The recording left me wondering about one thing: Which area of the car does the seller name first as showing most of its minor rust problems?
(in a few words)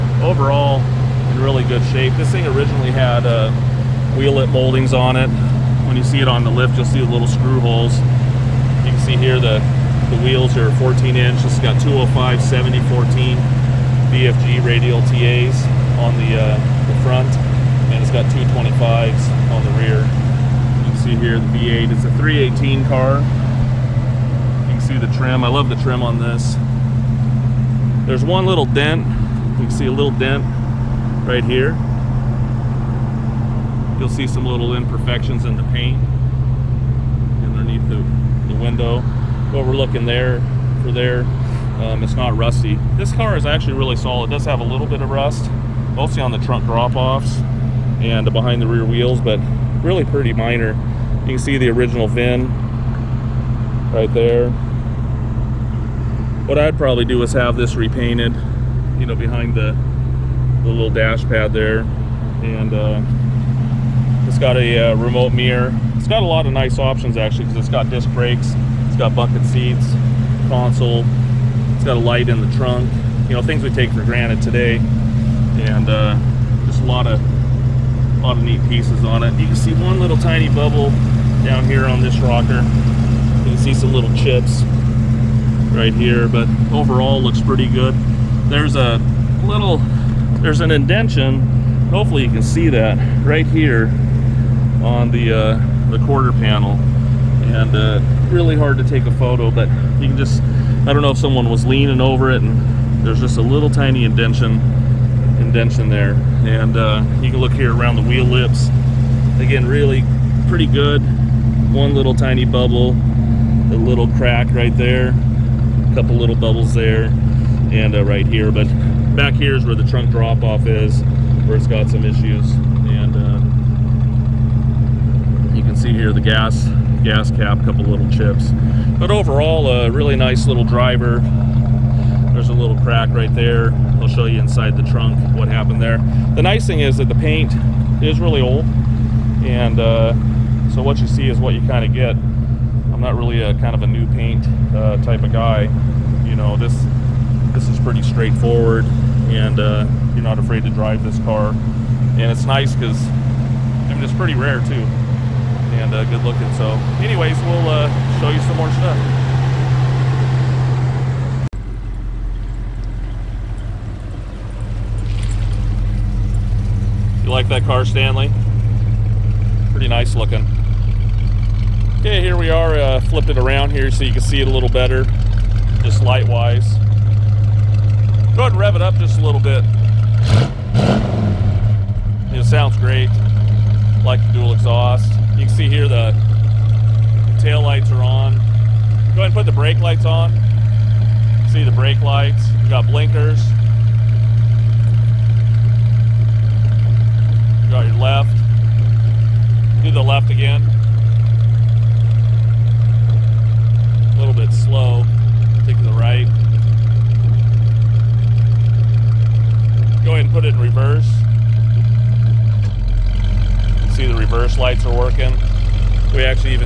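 trunk drop-offs.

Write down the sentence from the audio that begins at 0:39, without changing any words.
Overlooking there for there um, it's not rusty.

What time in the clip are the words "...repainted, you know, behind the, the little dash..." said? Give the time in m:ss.
0:57.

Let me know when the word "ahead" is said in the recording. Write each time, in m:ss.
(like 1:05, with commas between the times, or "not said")
2:58, 3:09, 3:30.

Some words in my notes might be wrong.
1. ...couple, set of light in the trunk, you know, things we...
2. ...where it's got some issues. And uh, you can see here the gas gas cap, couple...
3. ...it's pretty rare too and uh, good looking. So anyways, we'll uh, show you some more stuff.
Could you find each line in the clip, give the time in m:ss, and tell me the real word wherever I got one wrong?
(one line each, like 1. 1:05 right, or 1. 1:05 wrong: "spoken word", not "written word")
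1. 1:10 wrong: "console", not "couple"
2. 2:01 right
3. 2:34 right.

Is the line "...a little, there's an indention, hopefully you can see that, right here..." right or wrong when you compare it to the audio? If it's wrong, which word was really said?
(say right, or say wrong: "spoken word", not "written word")
right.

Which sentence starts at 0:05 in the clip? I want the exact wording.
When you see it on the lift, you'll see the little screw holes.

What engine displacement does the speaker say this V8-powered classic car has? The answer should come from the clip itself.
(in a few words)
318.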